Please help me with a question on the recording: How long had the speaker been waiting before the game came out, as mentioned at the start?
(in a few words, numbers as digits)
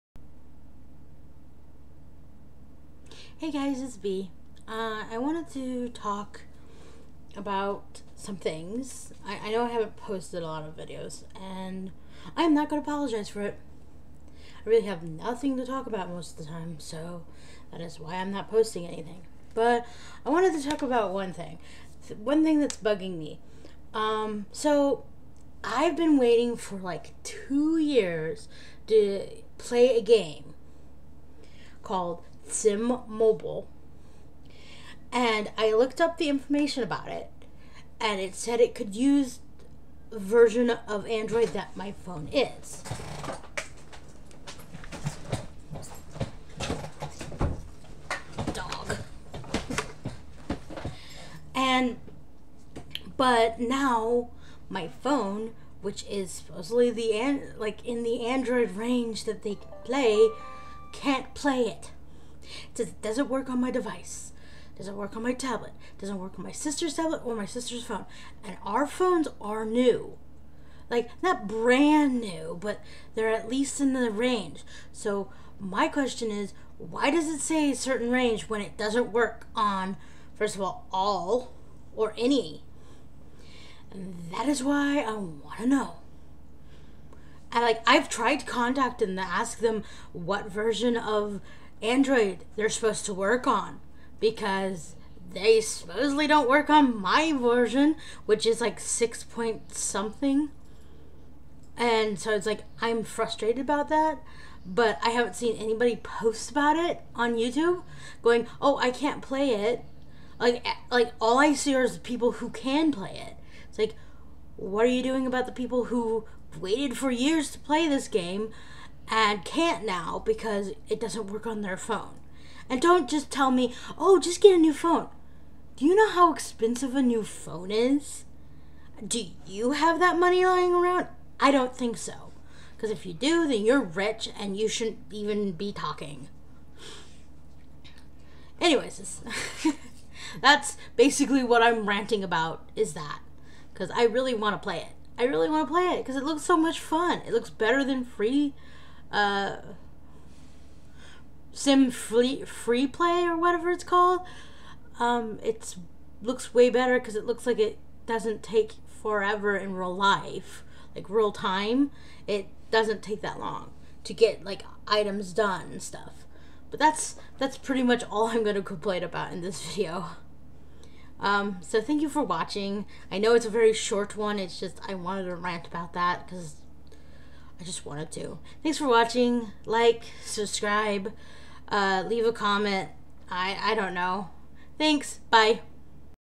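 2 years.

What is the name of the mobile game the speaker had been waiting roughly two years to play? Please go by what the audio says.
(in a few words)
Sims Mobile.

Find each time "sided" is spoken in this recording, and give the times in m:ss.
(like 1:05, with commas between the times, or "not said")
not said.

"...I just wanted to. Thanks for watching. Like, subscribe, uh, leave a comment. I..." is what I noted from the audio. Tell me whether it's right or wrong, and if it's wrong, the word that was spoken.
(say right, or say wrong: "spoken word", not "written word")
right.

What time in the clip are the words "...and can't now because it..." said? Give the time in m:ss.
1:59.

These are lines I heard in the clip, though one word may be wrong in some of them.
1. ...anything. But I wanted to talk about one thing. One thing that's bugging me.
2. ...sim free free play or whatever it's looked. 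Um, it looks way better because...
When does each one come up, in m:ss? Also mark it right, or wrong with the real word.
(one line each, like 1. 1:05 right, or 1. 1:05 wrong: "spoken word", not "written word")
1. 0:18 right
2. 2:31 wrong: "called", not "looked".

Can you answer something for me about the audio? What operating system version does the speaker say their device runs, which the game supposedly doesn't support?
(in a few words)
6 point something.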